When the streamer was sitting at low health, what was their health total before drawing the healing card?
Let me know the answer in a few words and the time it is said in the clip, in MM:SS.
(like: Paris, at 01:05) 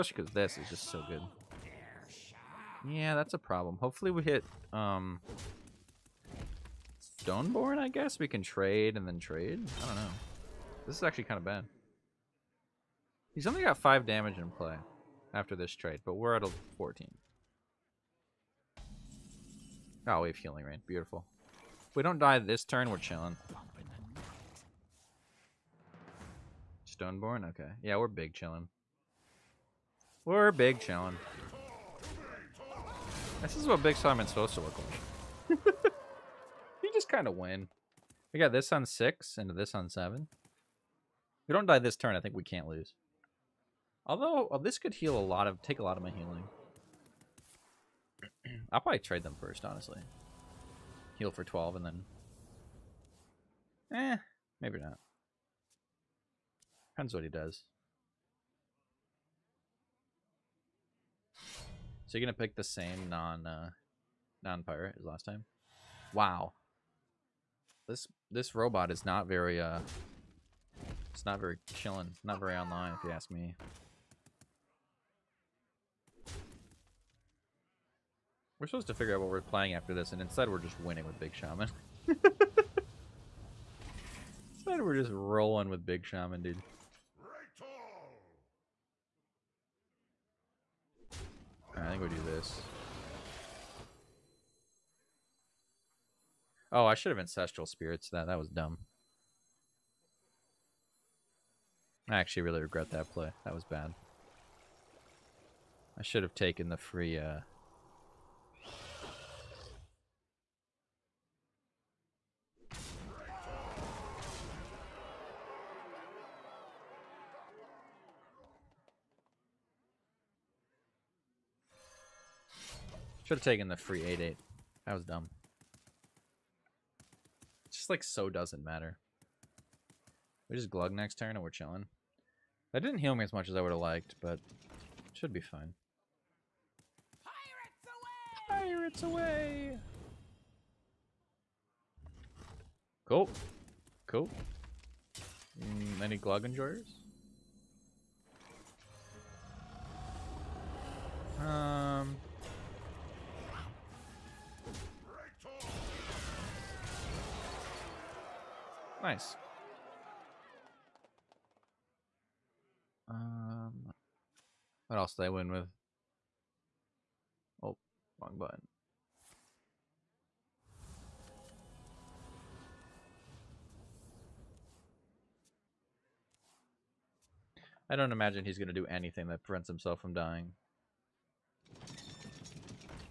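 14, at 00:16.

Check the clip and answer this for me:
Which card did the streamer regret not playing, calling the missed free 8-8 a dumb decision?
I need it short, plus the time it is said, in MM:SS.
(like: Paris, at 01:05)
Ancestral Spirits, at 01:37.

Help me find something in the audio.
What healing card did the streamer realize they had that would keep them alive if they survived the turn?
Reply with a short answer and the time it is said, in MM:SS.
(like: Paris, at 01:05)
Healing Rain, at 00:20.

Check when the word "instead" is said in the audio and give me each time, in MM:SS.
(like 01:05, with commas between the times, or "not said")
01:20, 01:24.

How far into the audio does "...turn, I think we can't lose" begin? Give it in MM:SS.
00:41.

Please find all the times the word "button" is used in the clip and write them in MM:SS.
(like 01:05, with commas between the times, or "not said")
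02:48.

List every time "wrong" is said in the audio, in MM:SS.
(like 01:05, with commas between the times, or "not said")
02:48.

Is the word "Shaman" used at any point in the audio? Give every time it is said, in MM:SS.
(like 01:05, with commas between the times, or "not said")
00:33, 01:21, 01:26.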